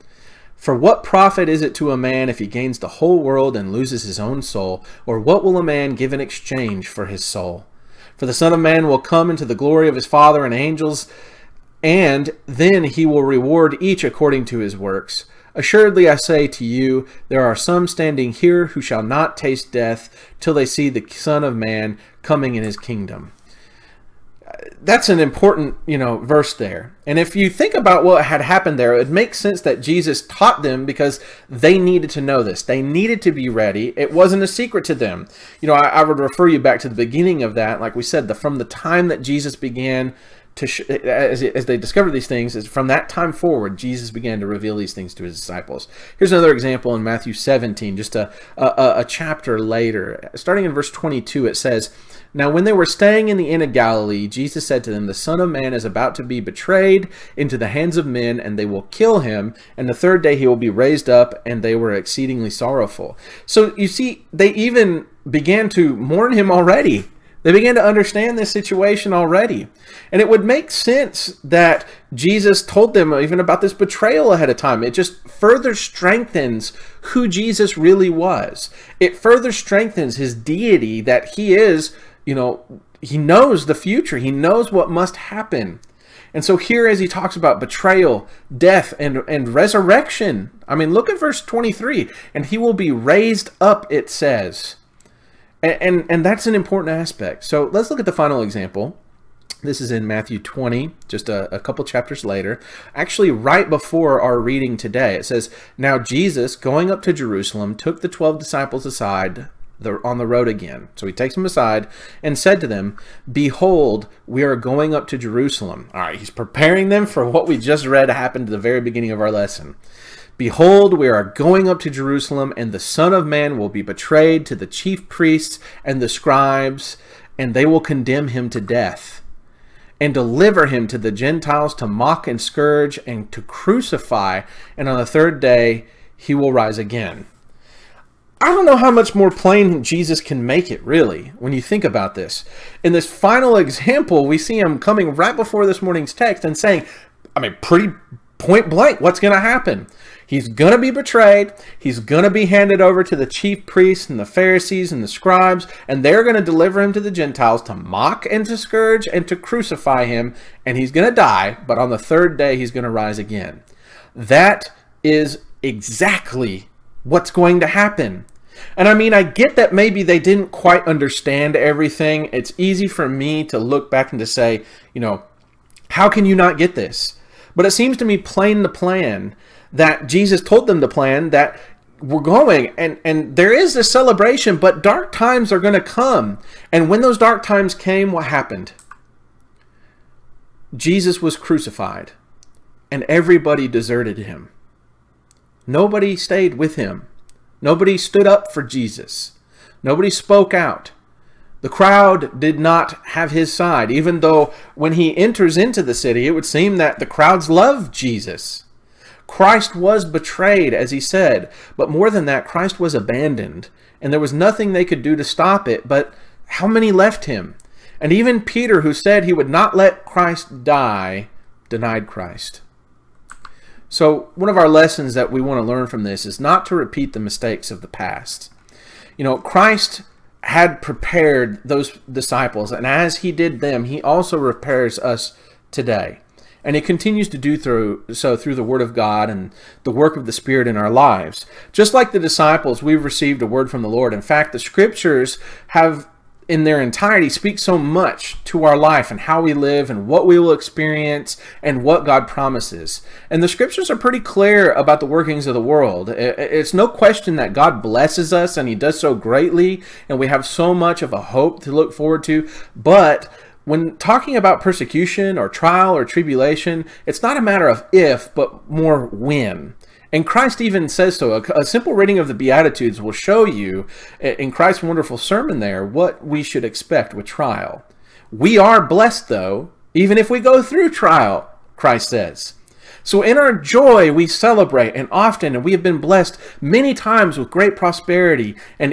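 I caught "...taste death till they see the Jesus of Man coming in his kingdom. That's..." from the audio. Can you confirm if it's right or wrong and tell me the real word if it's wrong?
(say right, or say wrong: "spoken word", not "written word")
wrong: "Son", not "Jesus".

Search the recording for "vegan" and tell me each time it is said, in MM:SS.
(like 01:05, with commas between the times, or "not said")
not said.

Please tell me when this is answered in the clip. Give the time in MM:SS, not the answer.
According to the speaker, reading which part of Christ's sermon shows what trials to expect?
04:32.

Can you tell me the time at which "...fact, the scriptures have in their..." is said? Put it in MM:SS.
04:04.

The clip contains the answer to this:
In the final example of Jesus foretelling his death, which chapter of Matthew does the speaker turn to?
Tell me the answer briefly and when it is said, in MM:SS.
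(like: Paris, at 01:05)
Matthew 20, at 01:40.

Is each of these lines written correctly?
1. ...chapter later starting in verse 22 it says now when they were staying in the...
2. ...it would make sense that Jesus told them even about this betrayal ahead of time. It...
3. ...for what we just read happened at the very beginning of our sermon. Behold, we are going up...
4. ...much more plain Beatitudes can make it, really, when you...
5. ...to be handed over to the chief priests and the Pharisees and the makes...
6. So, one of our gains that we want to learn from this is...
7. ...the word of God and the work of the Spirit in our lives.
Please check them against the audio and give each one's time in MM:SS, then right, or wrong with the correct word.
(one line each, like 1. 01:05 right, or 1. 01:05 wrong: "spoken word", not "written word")
1. 00:49 right
2. 01:10 right
3. 01:57 wrong: "lesson", not "sermon"
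4. 02:18 wrong: "Jesus", not "Beatitudes"
5. 02:32 wrong: "scribes", not "makes"
6. 03:43 wrong: "lessons", not "gains"
7. 03:58 right.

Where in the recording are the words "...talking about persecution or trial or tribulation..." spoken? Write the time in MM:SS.
04:23.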